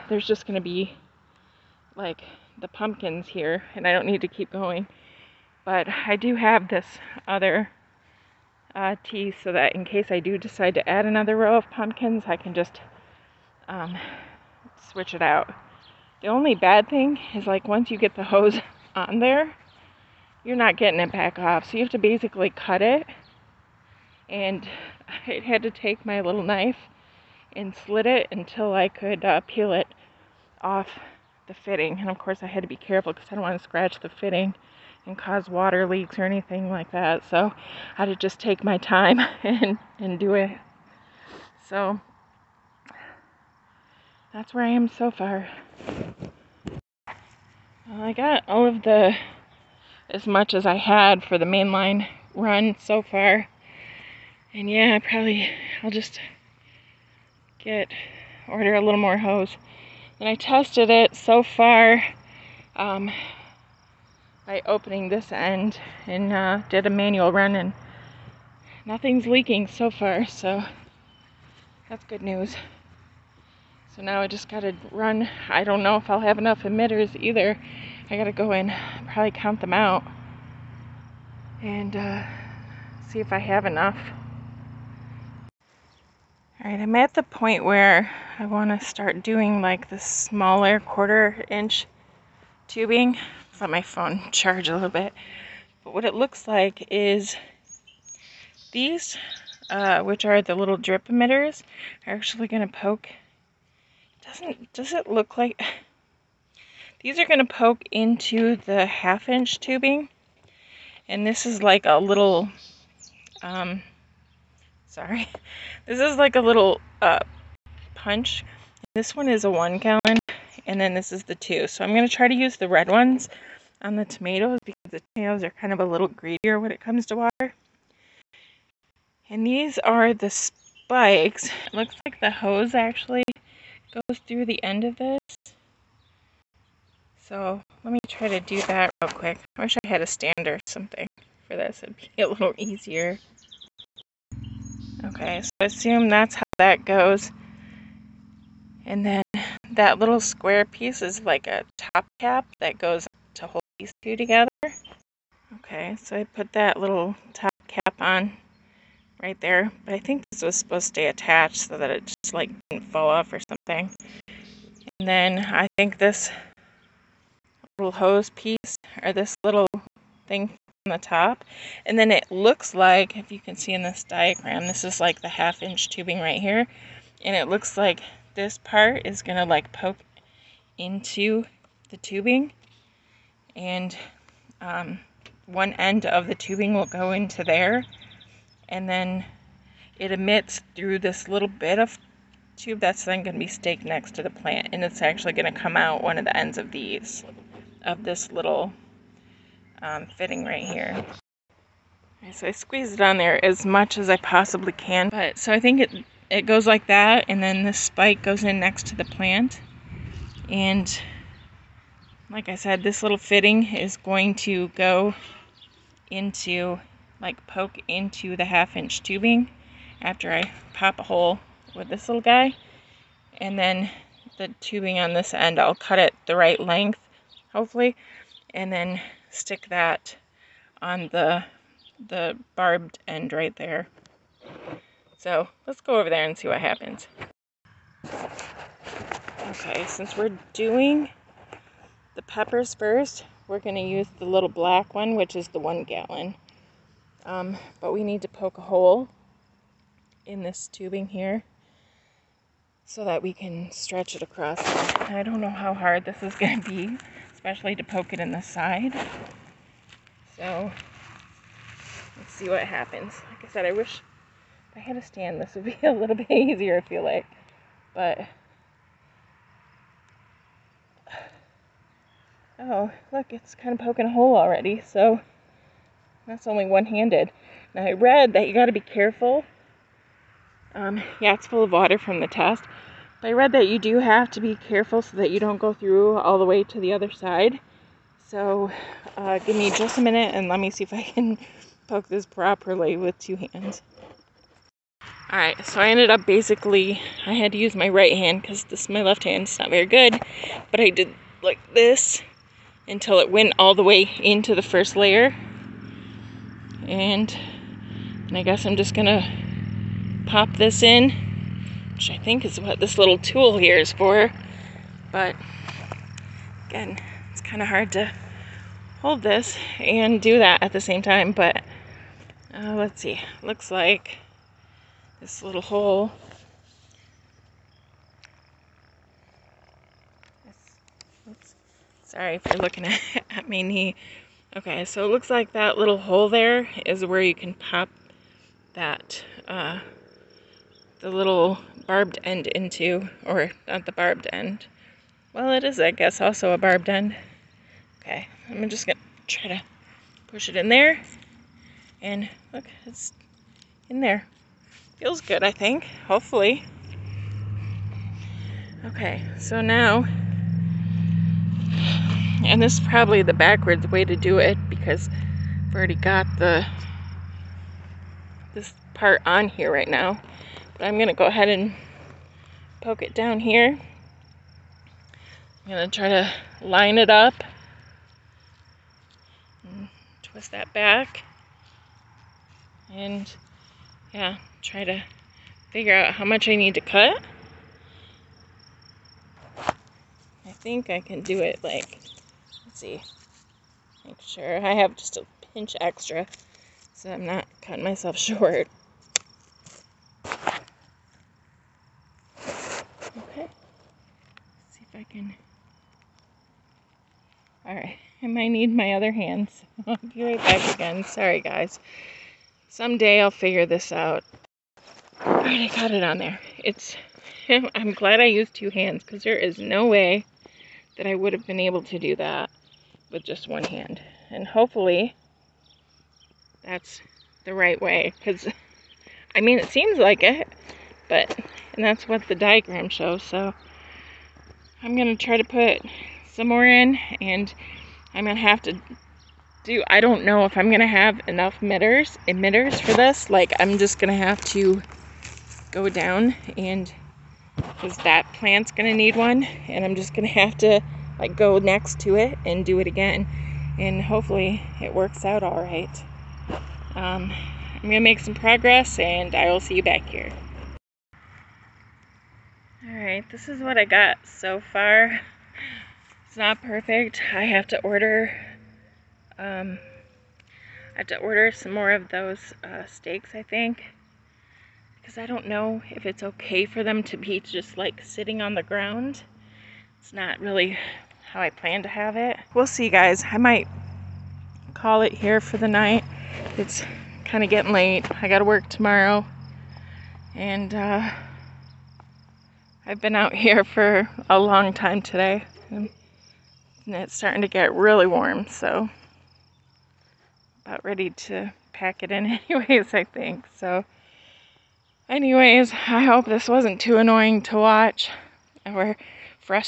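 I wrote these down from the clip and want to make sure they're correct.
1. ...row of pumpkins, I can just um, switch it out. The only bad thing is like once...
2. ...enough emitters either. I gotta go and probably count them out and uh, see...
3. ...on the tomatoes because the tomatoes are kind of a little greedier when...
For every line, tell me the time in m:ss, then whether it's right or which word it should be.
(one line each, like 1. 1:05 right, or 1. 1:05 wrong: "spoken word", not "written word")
1. 0:11 right
2. 1:16 right
3. 2:03 right.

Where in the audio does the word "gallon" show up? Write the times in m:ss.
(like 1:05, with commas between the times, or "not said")
1:59, 4:05.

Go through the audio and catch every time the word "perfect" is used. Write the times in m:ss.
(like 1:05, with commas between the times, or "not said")
7:46.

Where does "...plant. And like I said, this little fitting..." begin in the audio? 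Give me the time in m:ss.
3:29.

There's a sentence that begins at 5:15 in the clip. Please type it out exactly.
But again, it's kind of hard to hold this and do that at the same time.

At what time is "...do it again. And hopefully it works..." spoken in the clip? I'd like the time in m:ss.
7:32.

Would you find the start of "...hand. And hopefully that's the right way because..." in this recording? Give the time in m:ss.
7:03.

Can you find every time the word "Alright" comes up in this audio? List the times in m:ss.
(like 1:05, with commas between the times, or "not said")
4:55, 7:42.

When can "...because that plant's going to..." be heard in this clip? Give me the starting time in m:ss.
7:27.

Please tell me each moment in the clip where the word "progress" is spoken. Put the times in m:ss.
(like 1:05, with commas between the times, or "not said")
7:38.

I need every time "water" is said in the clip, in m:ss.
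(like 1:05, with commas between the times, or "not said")
0:35, 2:07, 4:41.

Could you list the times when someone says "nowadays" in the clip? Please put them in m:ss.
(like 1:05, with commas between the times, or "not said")
not said.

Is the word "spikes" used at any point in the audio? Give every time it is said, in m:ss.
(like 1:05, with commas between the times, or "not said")
2:10, 3:27.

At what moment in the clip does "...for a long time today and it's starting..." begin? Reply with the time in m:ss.
8:13.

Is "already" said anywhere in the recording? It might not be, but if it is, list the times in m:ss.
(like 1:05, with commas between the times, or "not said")
4:34, 6:05.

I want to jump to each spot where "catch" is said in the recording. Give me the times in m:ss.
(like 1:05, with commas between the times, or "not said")
not said.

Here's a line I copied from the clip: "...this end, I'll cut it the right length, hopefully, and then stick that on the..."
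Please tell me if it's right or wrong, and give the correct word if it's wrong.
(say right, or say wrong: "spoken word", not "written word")
right.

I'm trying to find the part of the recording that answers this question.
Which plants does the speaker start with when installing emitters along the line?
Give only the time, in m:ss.
4:02.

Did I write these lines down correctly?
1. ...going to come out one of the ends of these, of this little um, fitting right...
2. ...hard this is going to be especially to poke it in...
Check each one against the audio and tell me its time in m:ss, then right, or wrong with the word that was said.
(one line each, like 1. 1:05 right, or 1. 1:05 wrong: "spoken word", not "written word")
1. 3:15 right
2. 4:15 right.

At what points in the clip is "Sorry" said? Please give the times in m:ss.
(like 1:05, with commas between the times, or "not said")
1:54, 5:32, 6:51.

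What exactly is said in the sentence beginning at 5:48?
Okay, I'm just gonna try to push it in there.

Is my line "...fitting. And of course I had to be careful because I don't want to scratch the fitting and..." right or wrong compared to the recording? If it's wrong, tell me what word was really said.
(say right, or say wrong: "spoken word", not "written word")
right.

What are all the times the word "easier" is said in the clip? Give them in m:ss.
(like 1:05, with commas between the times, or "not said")
2:22, 4:26.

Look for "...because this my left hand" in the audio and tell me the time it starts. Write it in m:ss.
4:58.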